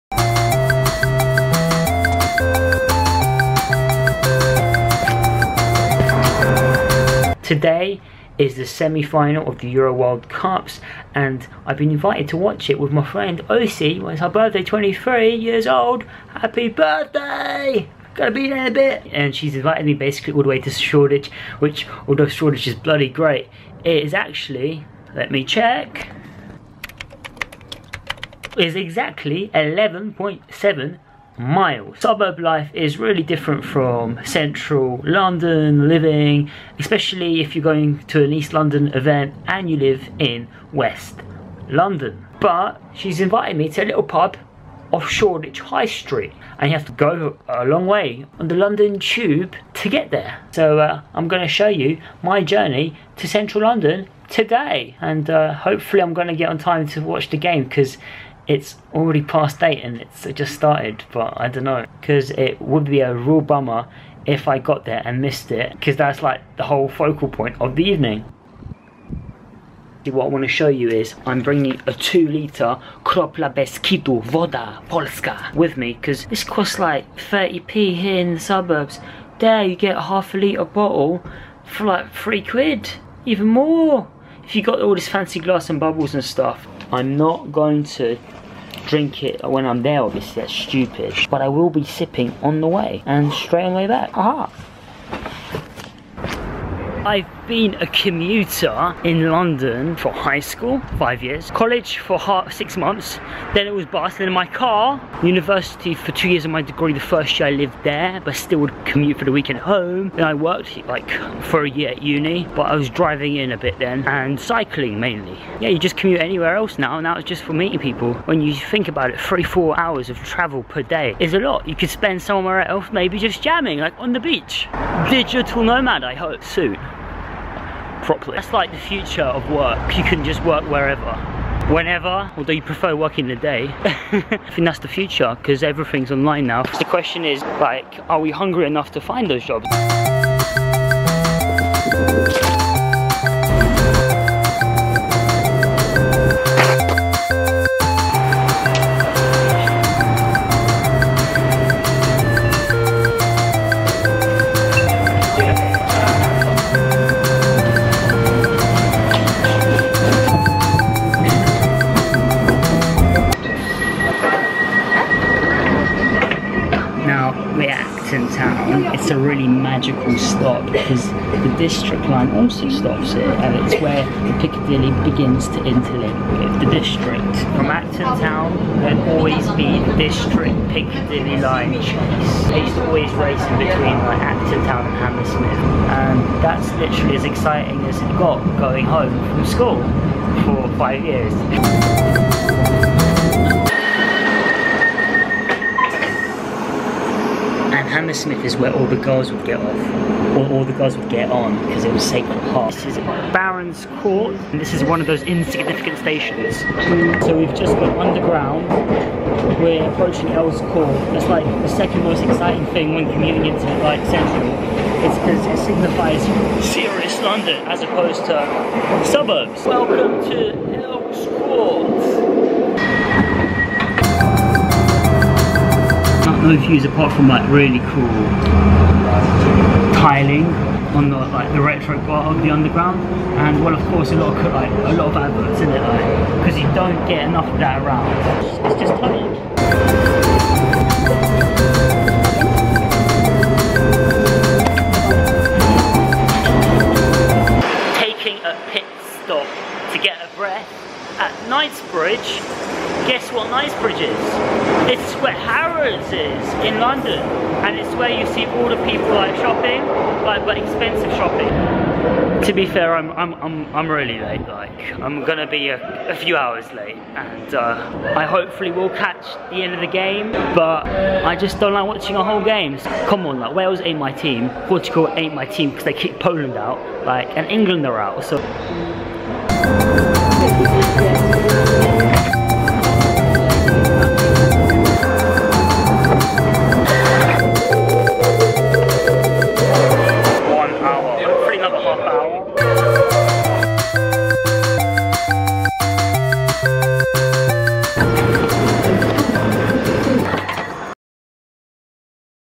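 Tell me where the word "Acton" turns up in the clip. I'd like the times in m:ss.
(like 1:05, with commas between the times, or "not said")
2:57, 3:04.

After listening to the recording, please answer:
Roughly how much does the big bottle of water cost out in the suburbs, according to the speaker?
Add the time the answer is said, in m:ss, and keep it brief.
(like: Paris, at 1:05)
30p, at 1:17.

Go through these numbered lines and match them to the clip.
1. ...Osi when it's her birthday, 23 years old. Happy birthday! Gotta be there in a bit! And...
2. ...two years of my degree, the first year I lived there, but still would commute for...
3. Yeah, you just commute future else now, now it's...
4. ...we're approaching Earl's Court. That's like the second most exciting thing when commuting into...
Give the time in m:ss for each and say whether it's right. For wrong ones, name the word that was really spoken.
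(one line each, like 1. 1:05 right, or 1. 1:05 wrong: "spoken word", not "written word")
1. 0:13 right
2. 1:46 right
3. 1:55 wrong: "anywhere", not "future"
4. 3:29 right.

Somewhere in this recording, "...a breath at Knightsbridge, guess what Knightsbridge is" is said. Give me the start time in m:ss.
4:10.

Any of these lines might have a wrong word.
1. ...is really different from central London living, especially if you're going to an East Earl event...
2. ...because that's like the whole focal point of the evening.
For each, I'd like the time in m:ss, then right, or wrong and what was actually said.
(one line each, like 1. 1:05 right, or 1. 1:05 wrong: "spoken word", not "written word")
1. 0:32 wrong: "London", not "Earl"
2. 1:05 right.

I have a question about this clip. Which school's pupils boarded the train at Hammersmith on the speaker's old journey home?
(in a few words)
Sacred Heart.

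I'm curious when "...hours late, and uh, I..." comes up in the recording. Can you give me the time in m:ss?
4:26.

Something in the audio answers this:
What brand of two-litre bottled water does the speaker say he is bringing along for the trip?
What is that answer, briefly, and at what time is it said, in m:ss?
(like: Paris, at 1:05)
Kropla Beskidu, at 1:13.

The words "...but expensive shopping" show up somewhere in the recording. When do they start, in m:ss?
4:20.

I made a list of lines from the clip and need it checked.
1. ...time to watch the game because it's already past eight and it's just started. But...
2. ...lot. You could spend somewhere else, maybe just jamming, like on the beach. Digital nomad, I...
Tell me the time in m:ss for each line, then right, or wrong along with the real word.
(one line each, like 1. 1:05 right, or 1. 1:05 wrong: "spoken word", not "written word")
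1. 0:56 right
2. 2:01 right.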